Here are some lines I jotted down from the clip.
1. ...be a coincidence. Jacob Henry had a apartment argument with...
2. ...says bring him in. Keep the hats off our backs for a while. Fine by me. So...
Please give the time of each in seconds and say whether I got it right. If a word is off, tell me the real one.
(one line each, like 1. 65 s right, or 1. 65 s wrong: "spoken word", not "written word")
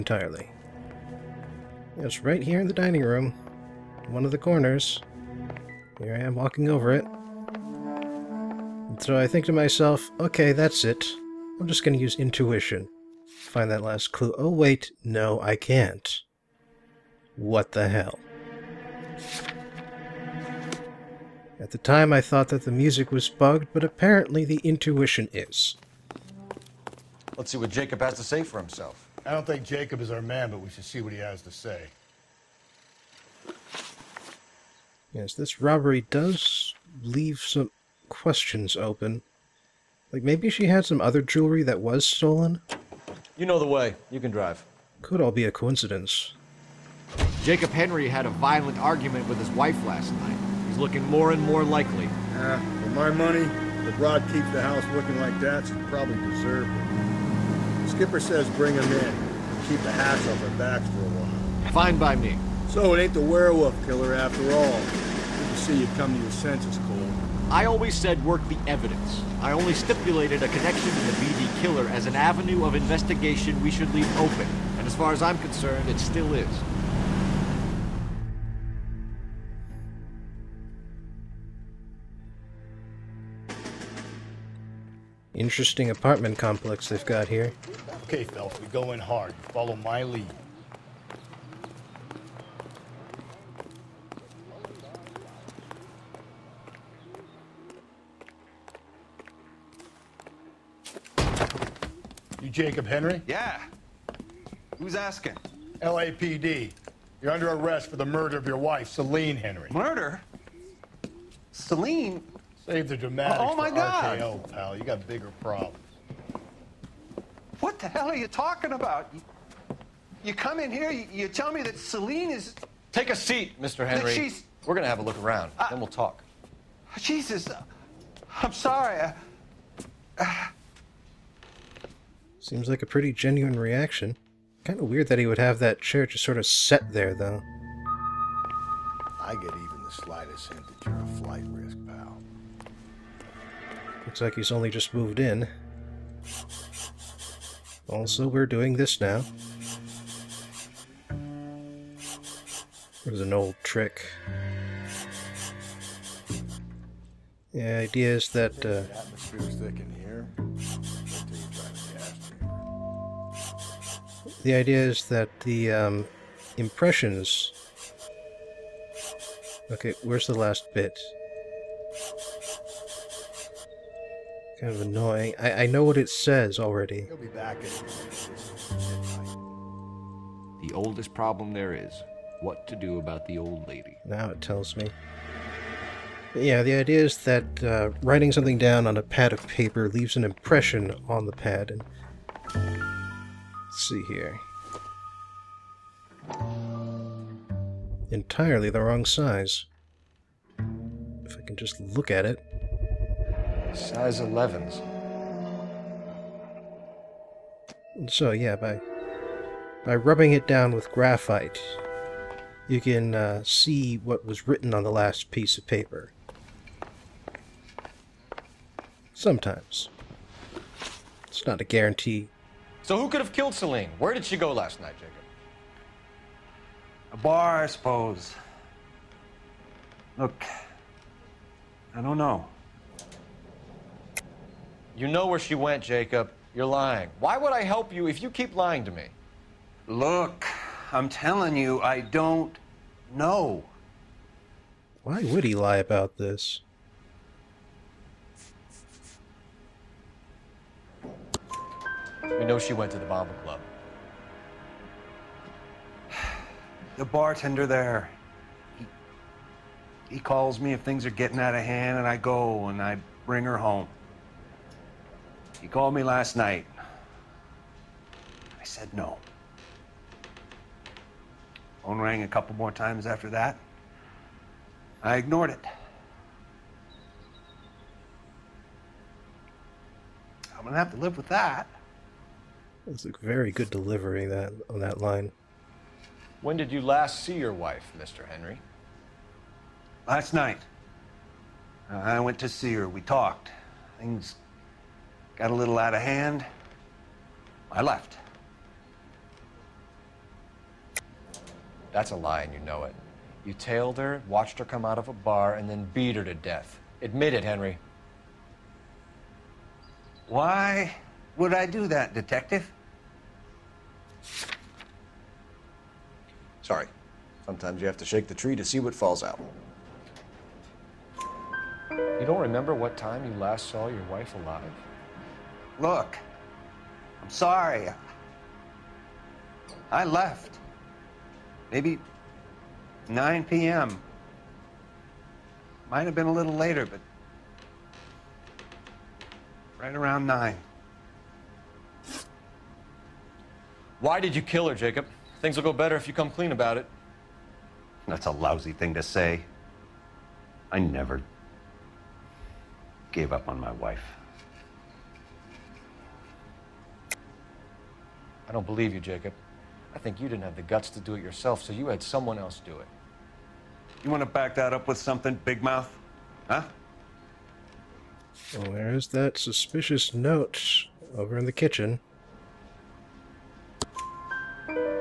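1. 45 s wrong: "violent", not "apartment"
2. 58 s right.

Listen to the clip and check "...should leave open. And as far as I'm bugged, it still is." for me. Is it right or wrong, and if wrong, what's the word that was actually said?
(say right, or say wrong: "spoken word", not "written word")
wrong: "concerned", not "bugged".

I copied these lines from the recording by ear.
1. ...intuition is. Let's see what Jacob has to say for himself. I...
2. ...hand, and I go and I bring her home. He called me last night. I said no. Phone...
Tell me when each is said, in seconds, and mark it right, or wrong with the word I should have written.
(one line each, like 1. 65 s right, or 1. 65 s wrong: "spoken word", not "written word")
1. 24 s right
2. 261 s right.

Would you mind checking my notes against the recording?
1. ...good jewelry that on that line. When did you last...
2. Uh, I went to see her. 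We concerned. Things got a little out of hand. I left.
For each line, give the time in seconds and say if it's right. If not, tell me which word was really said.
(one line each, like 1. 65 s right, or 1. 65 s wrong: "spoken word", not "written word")
1. 283 s wrong: "delivery", not "jewelry"
2. 291 s wrong: "talked", not "concerned".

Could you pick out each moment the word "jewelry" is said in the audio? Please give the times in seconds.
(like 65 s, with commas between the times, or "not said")
41 s.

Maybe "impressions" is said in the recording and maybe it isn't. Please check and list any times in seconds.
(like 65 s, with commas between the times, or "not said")
166 s, 190 s.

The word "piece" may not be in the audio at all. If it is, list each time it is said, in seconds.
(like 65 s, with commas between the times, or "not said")
215 s.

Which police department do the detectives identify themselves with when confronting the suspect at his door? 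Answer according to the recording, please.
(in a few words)
LAPD.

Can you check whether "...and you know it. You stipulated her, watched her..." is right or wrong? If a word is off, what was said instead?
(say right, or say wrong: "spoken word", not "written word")
wrong: "tailed", not "stipulated".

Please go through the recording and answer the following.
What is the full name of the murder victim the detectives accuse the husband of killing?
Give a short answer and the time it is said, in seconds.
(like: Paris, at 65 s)
Celine Henry, at 108 s.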